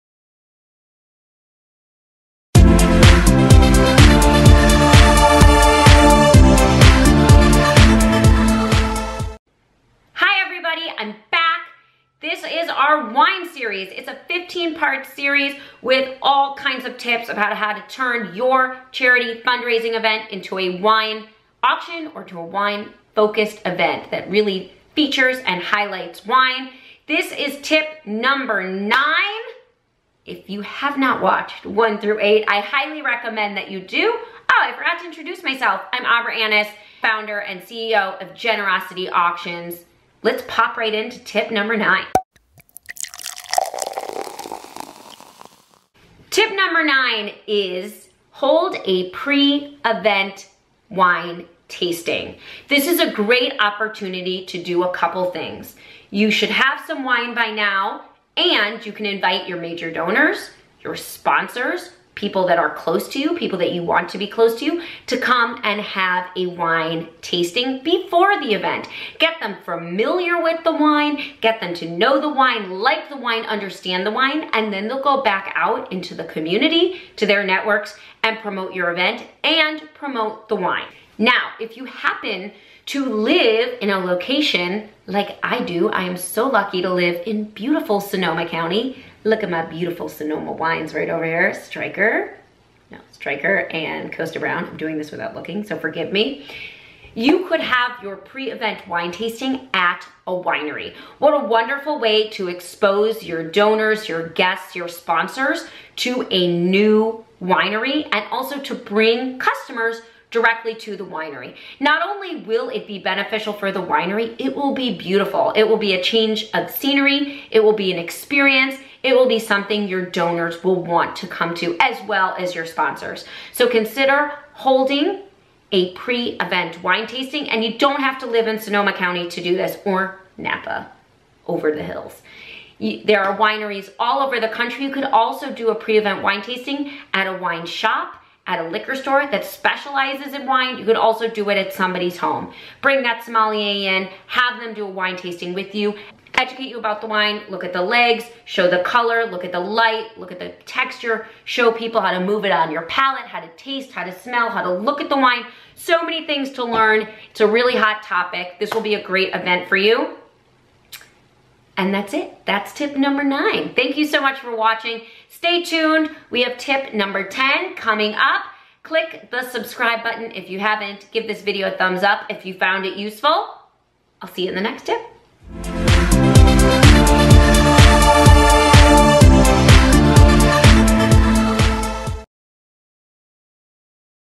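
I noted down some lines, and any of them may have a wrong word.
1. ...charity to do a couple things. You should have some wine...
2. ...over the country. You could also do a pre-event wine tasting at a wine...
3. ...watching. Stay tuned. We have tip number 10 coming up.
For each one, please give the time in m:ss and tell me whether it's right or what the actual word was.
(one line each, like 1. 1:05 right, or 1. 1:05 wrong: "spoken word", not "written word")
1. 0:53 wrong: "opportunity", not "charity"
2. 2:14 right
3. 2:44 right.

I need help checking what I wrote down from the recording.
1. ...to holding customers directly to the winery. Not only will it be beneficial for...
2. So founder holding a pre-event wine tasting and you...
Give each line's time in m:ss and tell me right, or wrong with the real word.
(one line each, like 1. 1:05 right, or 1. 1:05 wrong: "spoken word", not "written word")
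1. 1:48 wrong: "bring", not "holding"
2. 2:03 wrong: "consider", not "founder".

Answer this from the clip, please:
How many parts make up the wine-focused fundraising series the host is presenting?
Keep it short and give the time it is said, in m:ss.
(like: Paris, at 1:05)
15, at 0:14.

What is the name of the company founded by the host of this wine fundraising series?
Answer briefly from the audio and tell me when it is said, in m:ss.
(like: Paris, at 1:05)
Generosity Auctions, at 0:38.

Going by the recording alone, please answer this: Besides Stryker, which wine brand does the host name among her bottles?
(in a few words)
Kosta Browne.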